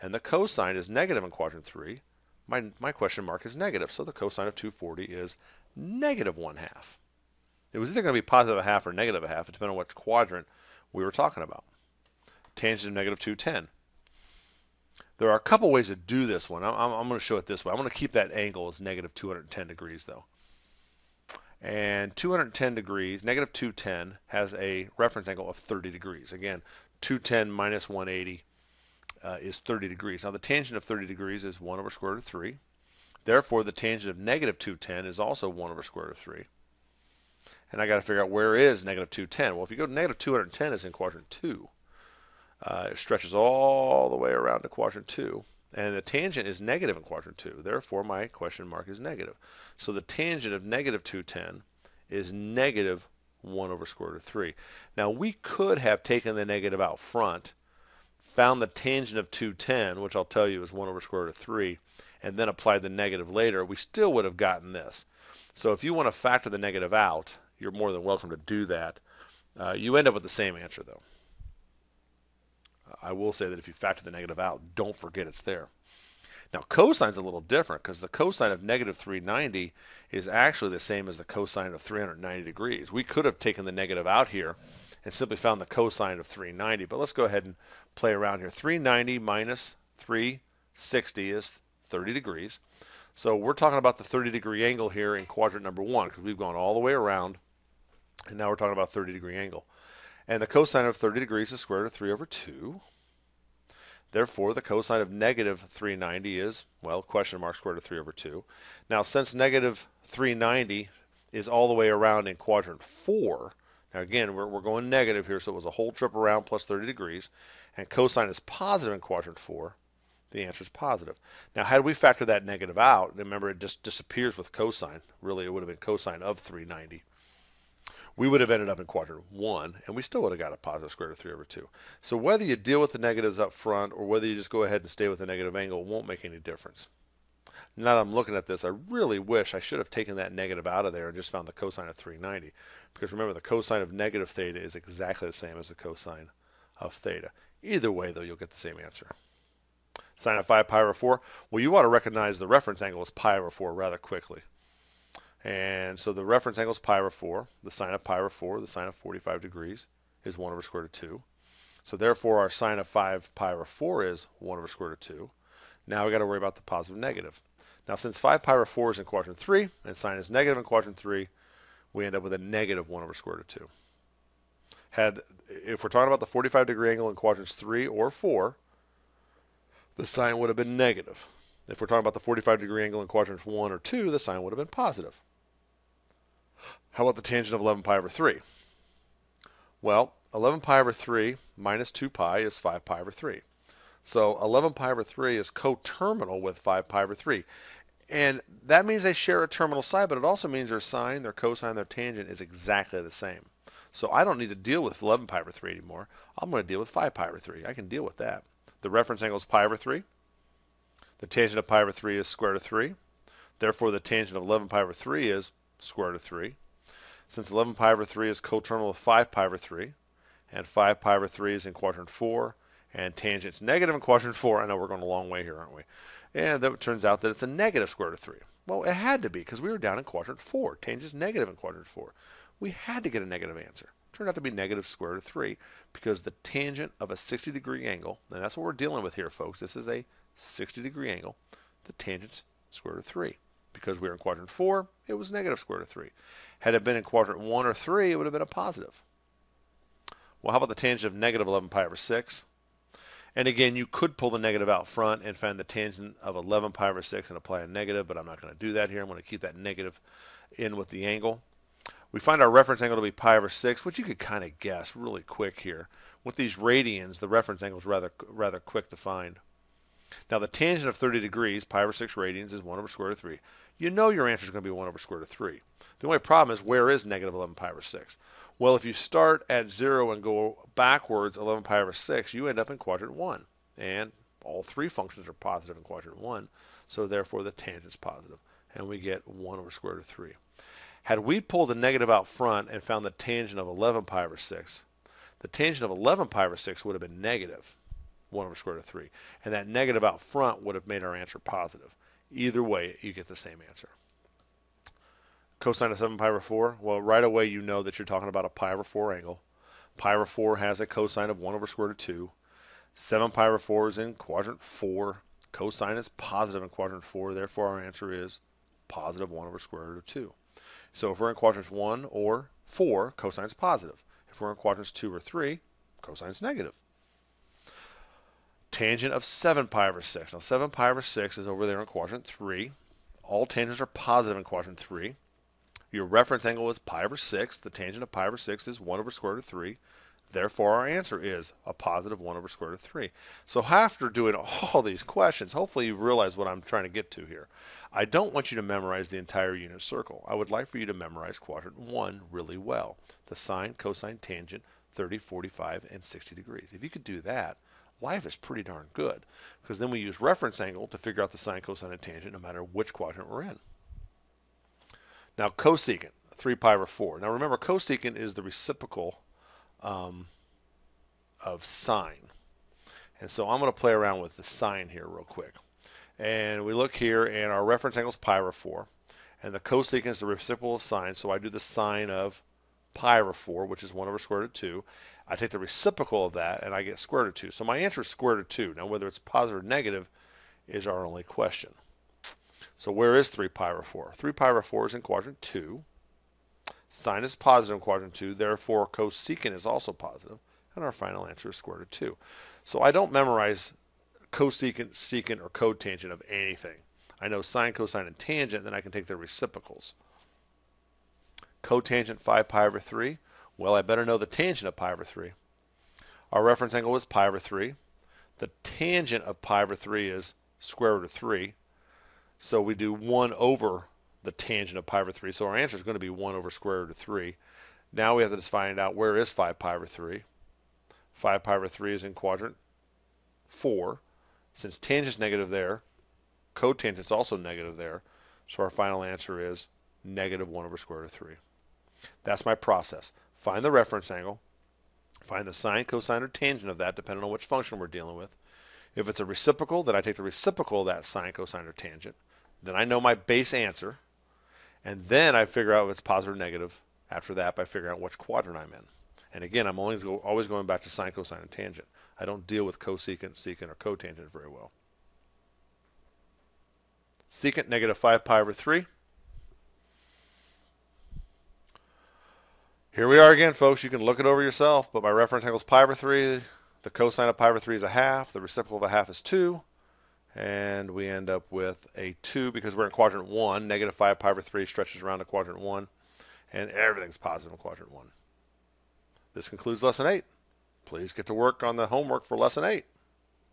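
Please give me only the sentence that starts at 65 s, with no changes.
So if you want to factor the negative out, you're more than welcome to do that.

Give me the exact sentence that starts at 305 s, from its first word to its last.
Cosine of 7 pi over 4, well, right away you know that you're talking about a pi over 4 angle.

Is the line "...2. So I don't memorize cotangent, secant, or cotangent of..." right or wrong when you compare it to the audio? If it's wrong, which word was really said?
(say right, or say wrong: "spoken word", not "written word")
wrong: "cosecant", not "cotangent".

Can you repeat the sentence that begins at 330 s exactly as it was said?
Now, 7 pi over 6 is over there in quadrant 3.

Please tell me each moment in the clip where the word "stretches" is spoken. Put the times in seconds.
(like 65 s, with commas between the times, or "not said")
42 s, 484 s.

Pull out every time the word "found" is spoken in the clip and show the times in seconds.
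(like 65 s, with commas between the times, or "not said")
58 s, 85 s, 141 s, 292 s.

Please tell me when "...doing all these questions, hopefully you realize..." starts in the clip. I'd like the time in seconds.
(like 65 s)
344 s.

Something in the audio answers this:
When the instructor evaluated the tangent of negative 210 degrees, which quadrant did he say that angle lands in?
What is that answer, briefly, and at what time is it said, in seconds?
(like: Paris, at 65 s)
quadrant 2, at 40 s.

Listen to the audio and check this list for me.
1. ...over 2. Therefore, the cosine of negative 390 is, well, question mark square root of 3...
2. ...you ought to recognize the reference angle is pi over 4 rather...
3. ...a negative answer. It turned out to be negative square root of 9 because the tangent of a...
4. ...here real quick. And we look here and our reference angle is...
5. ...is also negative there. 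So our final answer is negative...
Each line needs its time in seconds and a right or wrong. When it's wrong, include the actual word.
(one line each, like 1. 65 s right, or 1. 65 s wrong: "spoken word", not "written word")
1. 102 s right
2. 151 s right
3. 233 s wrong: "3", not "9"
4. 374 s right
5. 436 s right.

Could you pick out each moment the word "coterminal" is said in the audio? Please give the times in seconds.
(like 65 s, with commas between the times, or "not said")
195 s, 218 s.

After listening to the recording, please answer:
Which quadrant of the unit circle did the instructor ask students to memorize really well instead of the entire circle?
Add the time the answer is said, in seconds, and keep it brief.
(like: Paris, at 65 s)
quadrant 1, at 350 s.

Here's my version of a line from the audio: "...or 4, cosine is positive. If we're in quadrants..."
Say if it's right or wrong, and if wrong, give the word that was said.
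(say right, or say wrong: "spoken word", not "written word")
right.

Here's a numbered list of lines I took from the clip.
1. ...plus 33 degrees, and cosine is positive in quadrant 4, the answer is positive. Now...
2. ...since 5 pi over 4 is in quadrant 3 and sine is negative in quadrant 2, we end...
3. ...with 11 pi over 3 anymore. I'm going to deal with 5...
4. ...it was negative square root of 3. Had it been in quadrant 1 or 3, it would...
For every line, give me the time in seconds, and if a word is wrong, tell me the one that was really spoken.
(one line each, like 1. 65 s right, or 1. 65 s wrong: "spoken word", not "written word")
1. 116 s wrong: "30", not "33"
2. 167 s wrong: "3", not "2"
3. 204 s right
4. 245 s right.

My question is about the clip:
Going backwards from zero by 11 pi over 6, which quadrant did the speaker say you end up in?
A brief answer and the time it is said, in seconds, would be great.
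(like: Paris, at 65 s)
quadrant 1, at 282 s.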